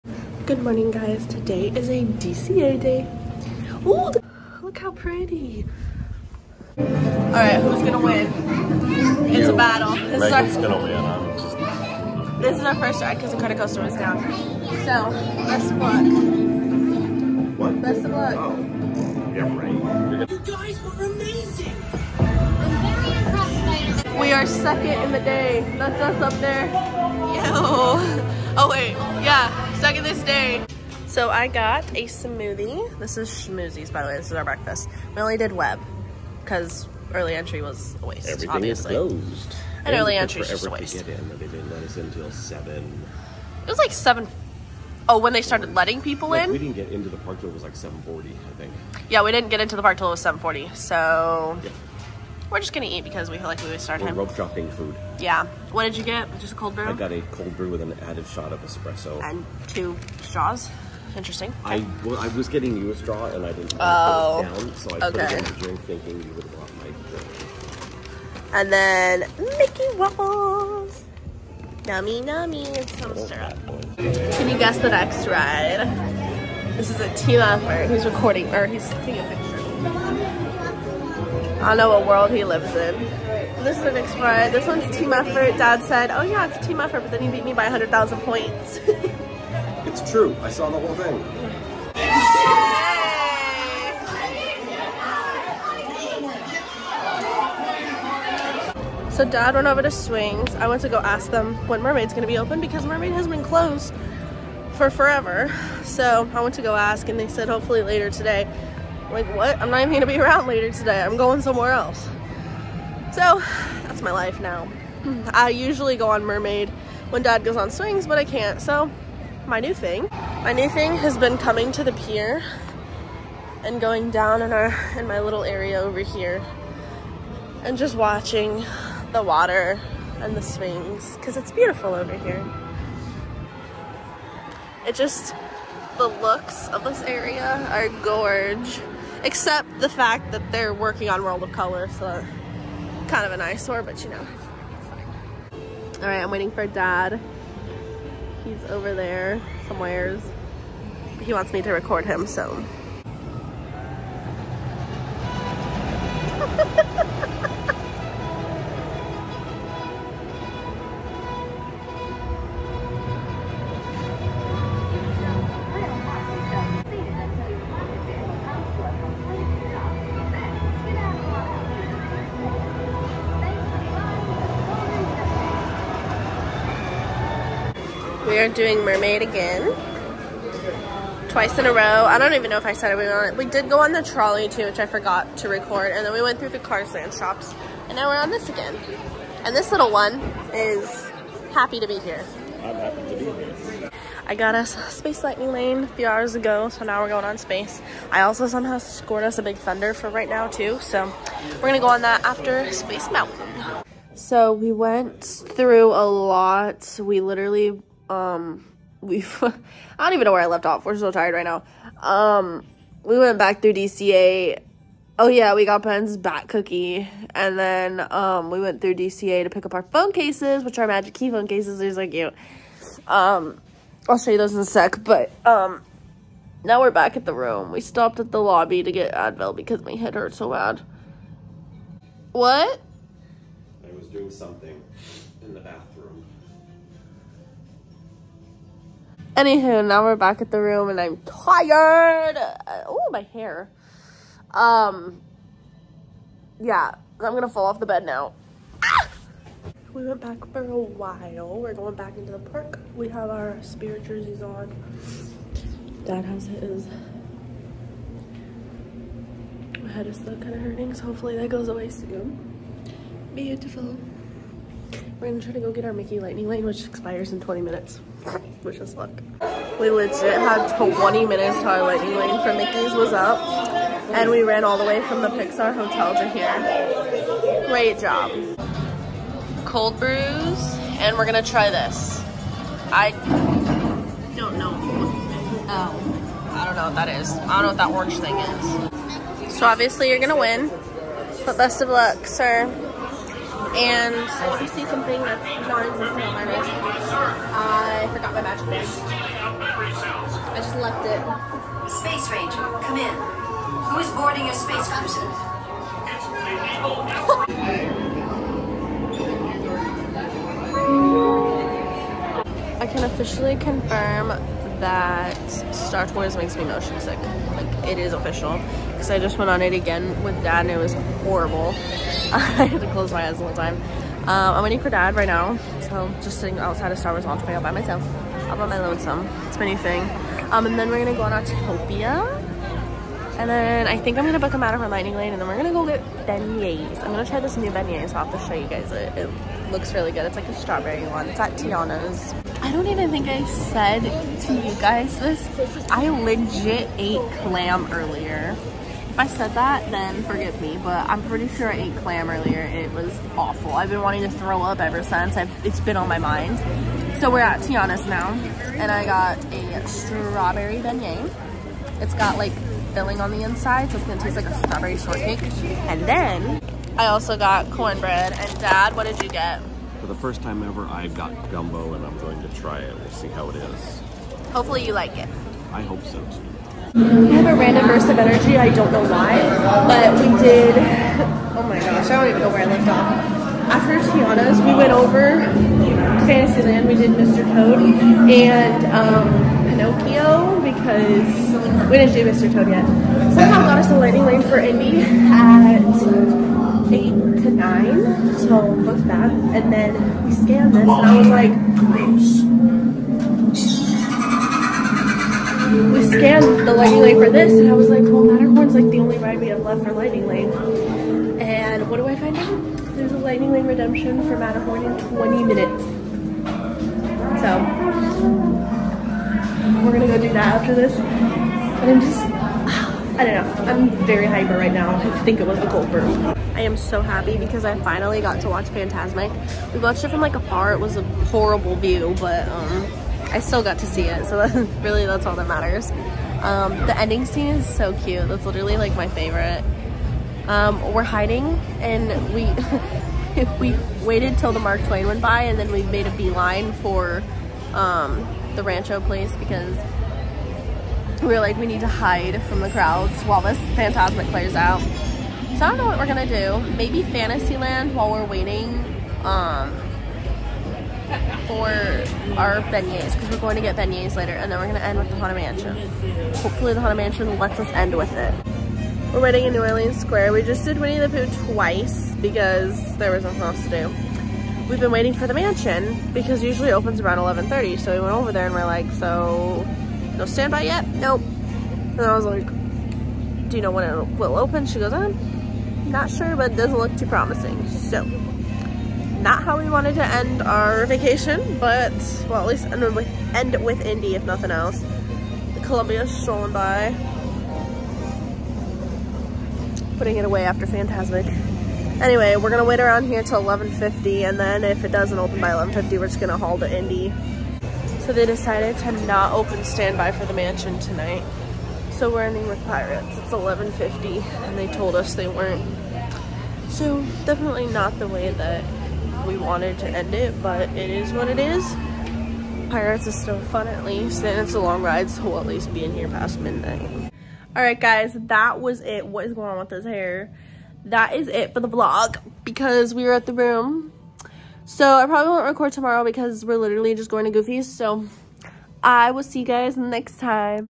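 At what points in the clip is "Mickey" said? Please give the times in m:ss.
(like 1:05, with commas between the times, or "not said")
1:09, 4:25, 4:32.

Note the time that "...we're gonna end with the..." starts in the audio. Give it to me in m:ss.
7:44.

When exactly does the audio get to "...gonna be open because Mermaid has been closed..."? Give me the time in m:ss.
1:42.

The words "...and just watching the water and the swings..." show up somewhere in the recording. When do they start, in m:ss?
2:07.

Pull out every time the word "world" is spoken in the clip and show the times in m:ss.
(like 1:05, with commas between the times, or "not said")
1:22, 2:21.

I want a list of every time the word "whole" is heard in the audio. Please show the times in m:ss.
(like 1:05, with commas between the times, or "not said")
1:30, 5:23.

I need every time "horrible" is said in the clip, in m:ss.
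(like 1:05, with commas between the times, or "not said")
5:21, 7:11.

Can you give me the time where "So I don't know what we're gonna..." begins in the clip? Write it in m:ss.
7:35.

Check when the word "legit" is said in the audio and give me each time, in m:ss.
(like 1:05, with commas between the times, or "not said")
4:29, 5:46.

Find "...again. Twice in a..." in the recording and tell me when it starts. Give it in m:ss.
2:59.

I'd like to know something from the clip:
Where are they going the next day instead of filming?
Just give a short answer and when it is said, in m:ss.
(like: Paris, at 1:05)
Goofy's, at 8:57.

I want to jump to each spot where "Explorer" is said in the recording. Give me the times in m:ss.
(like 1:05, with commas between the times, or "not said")
1:23.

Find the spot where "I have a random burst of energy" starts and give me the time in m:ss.
6:16.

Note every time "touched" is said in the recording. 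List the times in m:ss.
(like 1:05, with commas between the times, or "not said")
not said.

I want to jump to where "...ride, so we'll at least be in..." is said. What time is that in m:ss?
8:44.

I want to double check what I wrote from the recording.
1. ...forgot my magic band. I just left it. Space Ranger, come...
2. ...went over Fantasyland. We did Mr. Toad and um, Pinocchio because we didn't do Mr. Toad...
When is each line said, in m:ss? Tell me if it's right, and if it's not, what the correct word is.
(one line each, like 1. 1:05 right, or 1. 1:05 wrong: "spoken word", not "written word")
1. 4:58 right
2. 6:24 right.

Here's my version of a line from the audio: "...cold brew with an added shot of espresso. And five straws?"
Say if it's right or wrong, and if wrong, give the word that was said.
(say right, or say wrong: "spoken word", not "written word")
wrong: "two", not "five".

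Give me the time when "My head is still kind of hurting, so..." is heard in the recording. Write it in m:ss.
4:19.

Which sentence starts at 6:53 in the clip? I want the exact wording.
there's a Lightning Lane Redemption for Matterhorn in 20 minutes.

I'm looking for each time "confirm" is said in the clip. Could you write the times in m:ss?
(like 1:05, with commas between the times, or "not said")
5:13.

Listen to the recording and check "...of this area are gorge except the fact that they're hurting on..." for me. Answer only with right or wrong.
wrong.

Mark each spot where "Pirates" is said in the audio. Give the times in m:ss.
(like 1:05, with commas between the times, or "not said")
8:32, 8:42.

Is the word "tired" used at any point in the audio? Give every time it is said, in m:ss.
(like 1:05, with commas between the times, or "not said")
3:31, 4:01.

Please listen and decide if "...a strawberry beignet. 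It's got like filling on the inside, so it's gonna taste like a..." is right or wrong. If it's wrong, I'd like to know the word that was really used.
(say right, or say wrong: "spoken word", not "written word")
right.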